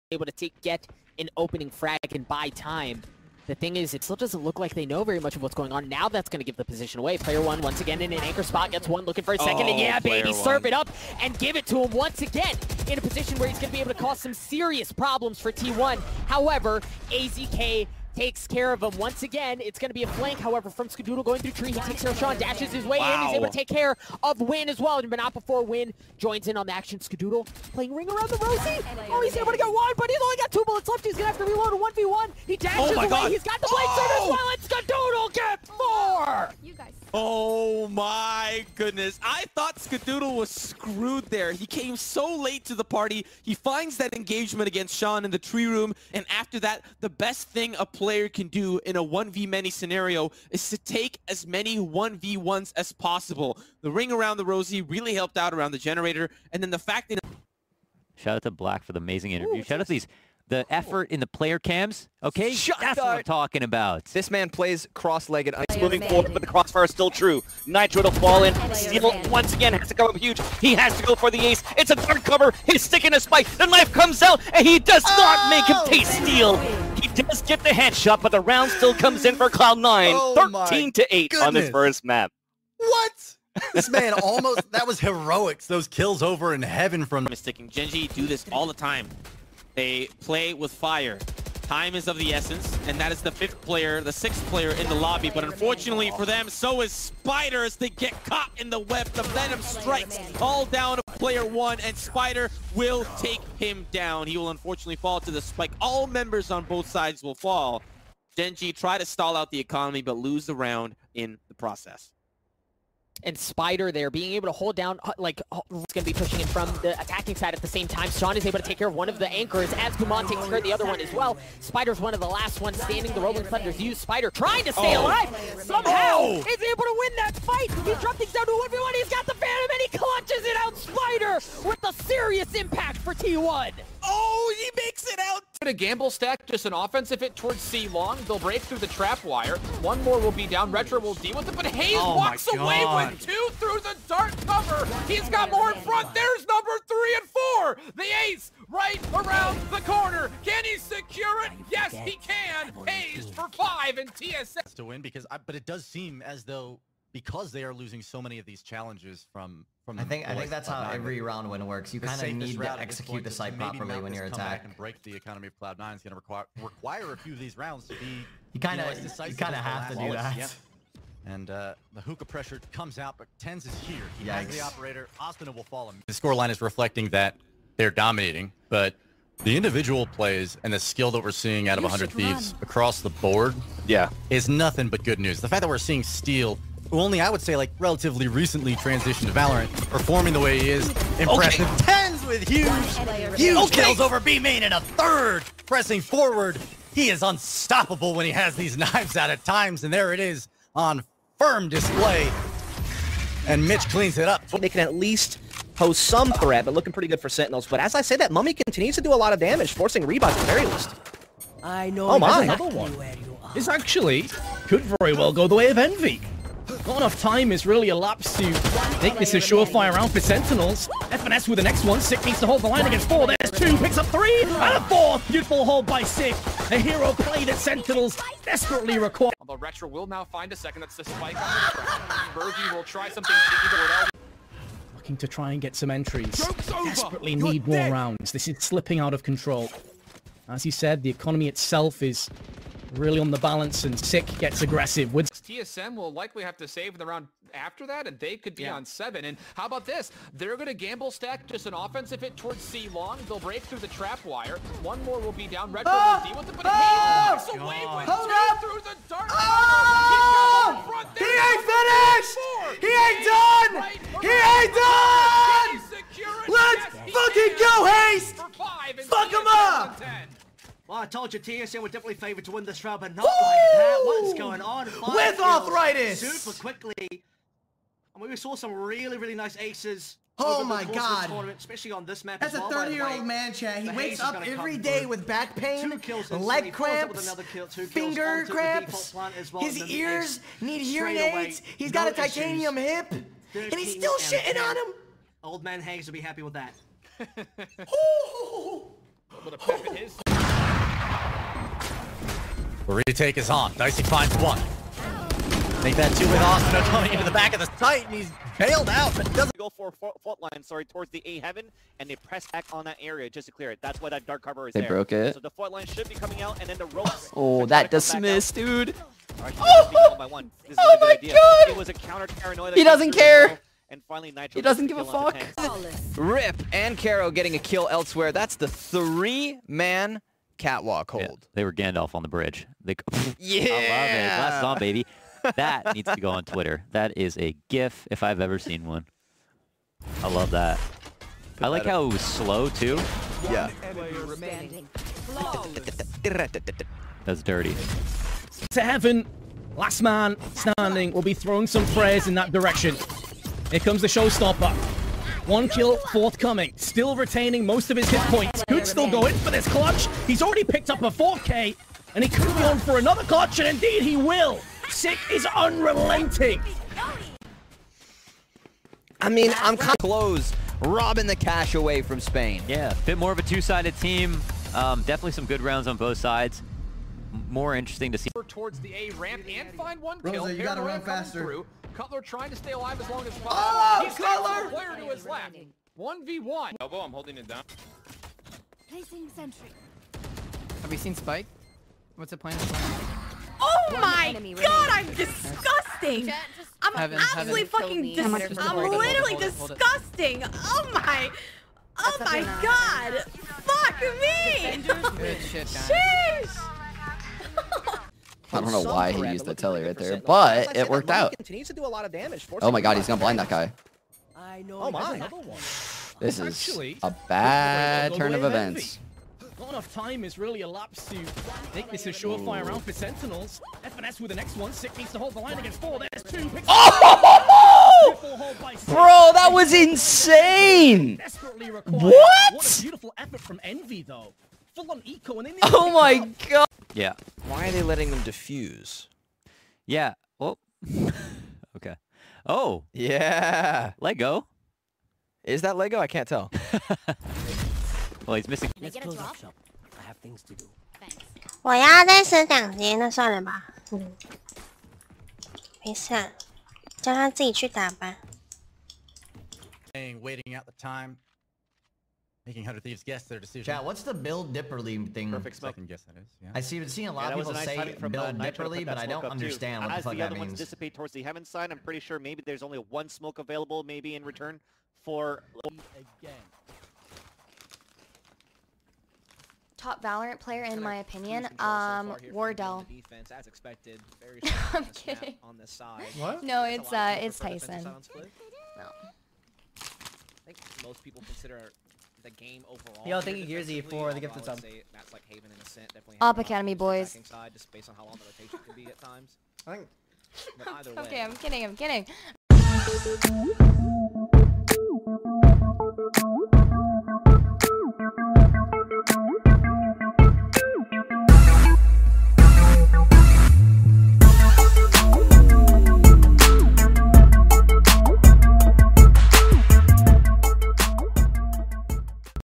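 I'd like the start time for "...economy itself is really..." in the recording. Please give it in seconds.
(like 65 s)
241 s.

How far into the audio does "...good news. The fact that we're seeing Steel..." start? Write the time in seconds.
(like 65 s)
185 s.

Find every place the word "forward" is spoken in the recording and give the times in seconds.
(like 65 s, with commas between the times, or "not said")
66 s, 196 s.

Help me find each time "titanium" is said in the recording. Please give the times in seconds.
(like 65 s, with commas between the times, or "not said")
292 s.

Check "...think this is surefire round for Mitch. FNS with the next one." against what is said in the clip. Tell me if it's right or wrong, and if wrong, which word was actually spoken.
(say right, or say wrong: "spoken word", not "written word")
wrong: "Sentinels", not "Mitch".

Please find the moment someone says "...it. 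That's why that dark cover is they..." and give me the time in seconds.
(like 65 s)
313 s.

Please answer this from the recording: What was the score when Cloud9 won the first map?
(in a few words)
13 to 8.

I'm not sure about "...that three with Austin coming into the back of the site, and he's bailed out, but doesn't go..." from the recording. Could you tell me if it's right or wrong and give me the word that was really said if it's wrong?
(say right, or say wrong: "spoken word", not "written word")
wrong: "two", not "three".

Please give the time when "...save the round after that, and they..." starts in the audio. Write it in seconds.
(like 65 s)
246 s.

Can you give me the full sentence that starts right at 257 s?
away with Hold two through the dark.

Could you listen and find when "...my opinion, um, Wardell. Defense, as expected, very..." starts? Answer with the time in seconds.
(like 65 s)
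480 s.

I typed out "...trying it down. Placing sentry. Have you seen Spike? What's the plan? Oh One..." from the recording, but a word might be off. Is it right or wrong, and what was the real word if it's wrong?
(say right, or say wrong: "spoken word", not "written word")
wrong: "holding", not "trying".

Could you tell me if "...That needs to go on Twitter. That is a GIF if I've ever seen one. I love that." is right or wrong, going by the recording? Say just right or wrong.
right.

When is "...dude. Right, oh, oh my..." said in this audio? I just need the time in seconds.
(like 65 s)
318 s.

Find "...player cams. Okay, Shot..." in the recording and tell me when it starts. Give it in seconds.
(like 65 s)
61 s.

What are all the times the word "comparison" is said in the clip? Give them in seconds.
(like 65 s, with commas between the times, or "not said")
not said.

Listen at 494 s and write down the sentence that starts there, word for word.
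That's like Haven and Ascent definitely.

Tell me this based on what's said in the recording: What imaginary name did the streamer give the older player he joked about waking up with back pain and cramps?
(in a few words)
Old man Hanks.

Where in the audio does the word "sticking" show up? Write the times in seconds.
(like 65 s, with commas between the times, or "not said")
72 s, 87 s.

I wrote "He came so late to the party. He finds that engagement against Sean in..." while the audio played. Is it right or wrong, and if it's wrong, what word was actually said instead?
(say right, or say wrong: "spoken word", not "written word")
right.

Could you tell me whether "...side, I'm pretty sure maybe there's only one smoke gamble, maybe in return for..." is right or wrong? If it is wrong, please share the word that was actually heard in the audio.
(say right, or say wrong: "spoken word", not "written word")
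wrong: "available", not "gamble".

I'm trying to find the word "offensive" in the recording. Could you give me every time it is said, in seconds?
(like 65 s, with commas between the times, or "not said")
136 s, 251 s.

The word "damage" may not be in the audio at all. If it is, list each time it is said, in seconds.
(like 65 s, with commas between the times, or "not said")
209 s, 412 s.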